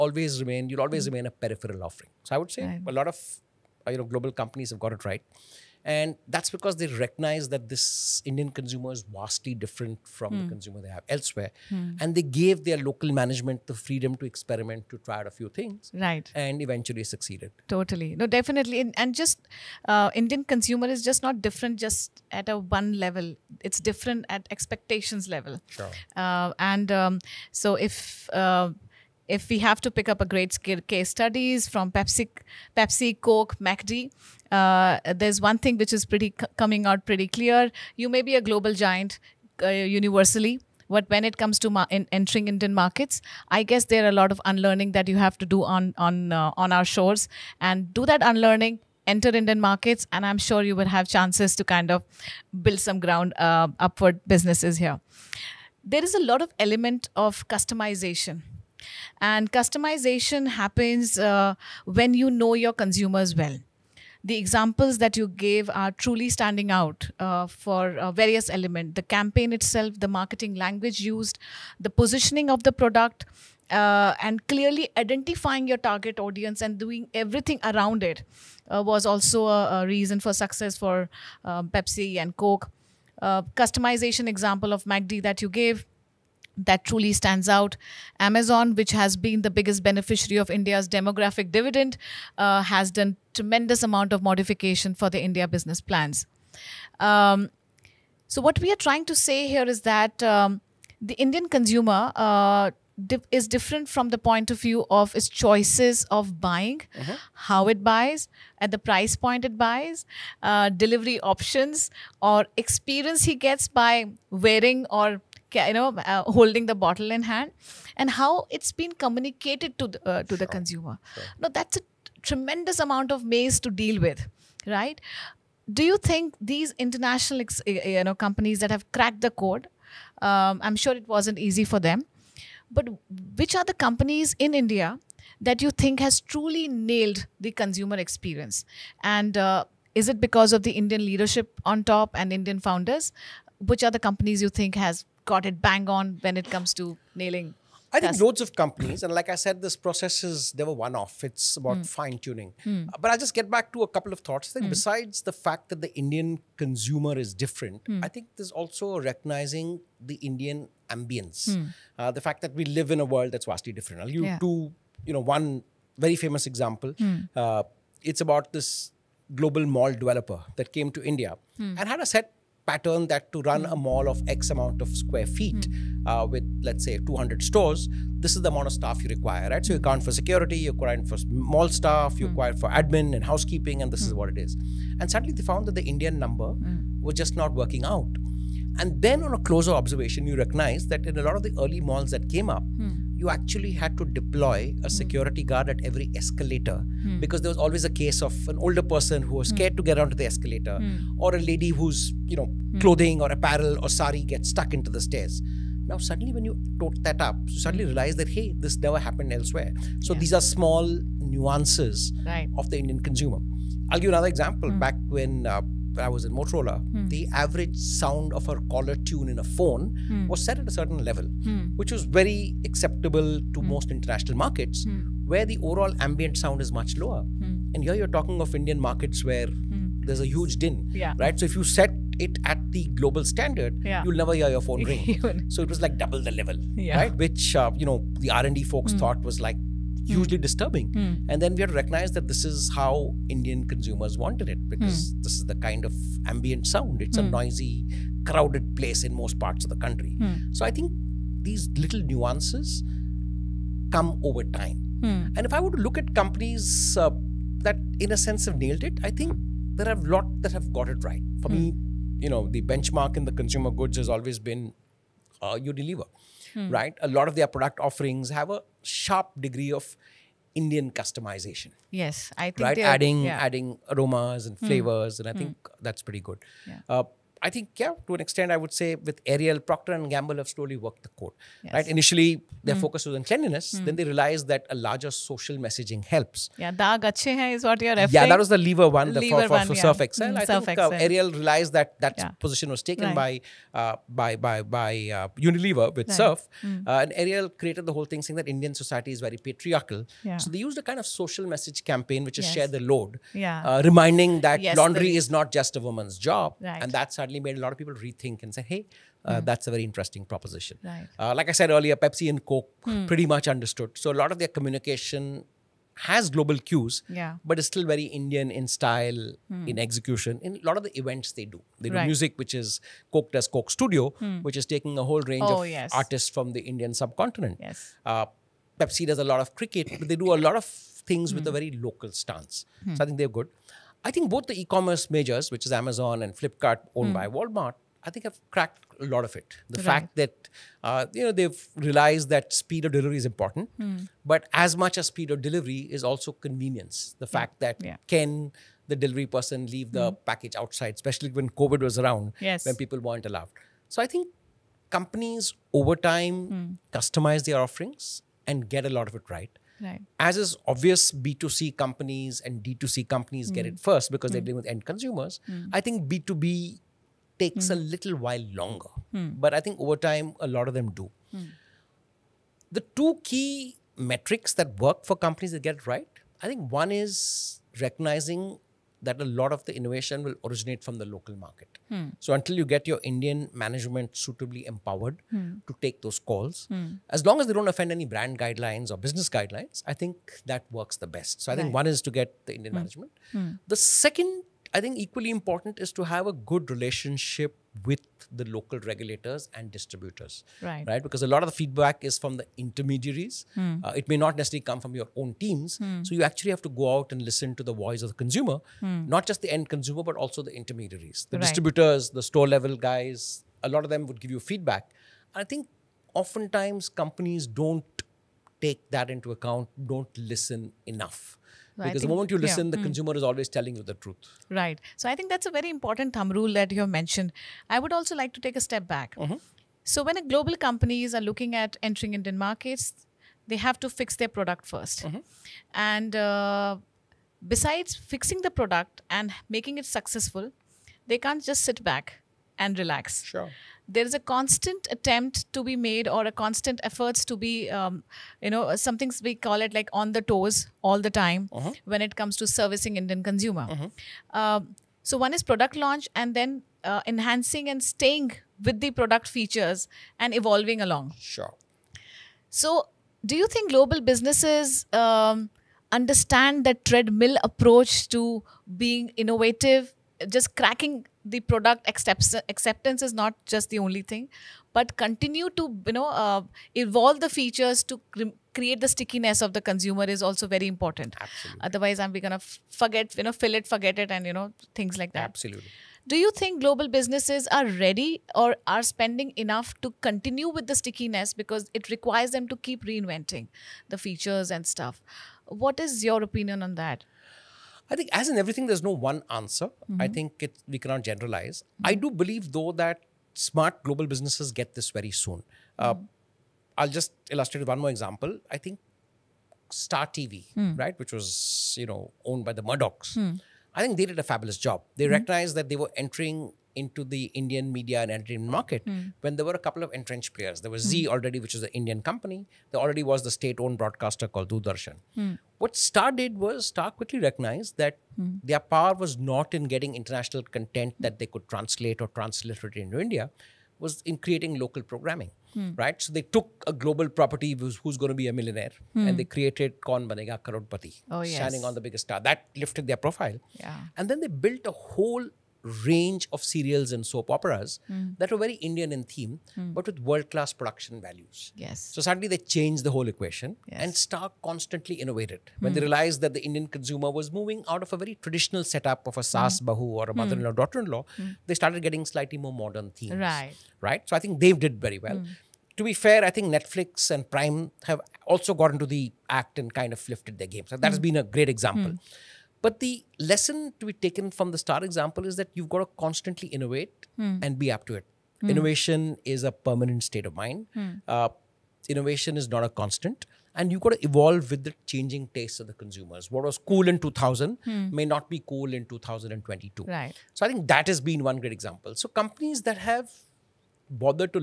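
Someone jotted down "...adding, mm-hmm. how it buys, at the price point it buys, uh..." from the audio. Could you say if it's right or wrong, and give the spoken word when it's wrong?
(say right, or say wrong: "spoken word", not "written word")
wrong: "buying", not "adding".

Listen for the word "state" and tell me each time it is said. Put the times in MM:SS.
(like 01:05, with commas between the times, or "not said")
08:43, 09:40.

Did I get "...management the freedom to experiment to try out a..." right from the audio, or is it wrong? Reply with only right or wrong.
right.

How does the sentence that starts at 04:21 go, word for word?
For me, you know, the benchmark in the consumer goods has always been uh, deliver, right?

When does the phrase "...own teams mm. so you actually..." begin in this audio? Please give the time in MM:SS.
06:45.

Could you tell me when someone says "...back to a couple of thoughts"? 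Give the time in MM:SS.
02:33.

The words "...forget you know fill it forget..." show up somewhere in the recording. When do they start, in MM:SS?
08:02.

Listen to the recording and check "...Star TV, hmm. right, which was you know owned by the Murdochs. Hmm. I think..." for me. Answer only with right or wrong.
right.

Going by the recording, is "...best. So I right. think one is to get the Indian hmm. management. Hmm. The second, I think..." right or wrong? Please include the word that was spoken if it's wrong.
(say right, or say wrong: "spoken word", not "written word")
right.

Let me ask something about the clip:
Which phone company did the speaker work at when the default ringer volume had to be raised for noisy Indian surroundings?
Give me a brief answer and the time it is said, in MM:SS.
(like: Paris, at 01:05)
Motorola, at 03:36.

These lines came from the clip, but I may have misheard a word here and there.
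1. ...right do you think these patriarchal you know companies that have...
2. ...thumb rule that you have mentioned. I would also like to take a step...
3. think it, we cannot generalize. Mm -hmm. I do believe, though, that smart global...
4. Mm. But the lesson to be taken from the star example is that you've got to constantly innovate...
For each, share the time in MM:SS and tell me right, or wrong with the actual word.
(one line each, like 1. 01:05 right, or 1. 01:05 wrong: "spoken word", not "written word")
1. 02:04 wrong: "international", not "patriarchal"
2. 07:06 right
3. 08:20 right
4. 09:31 right.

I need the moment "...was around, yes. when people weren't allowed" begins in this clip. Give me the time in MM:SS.
05:51.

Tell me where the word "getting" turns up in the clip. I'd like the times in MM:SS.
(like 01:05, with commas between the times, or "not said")
08:49, 09:21.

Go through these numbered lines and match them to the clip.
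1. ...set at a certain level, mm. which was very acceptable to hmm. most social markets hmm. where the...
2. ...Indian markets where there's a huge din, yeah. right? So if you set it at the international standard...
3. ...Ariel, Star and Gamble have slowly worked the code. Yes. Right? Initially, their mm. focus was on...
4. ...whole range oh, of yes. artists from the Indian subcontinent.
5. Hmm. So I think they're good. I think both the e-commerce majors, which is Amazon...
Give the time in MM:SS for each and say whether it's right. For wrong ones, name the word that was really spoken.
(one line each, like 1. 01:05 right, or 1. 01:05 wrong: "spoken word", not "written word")
1. 03:40 wrong: "international", not "social"
2. 03:48 wrong: "global", not "international"
3. 04:39 wrong: "Procter", not "Star"
4. 05:25 right
5. 05:32 right.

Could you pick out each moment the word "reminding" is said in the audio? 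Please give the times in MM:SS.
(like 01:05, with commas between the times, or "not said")
05:03.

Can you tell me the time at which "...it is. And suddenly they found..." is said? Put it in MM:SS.
03:04.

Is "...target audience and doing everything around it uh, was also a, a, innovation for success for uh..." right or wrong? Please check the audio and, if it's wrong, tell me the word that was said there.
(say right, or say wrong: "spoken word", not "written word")
wrong: "reason", not "innovation".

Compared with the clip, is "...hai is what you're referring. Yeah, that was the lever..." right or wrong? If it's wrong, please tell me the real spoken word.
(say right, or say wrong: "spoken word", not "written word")
right.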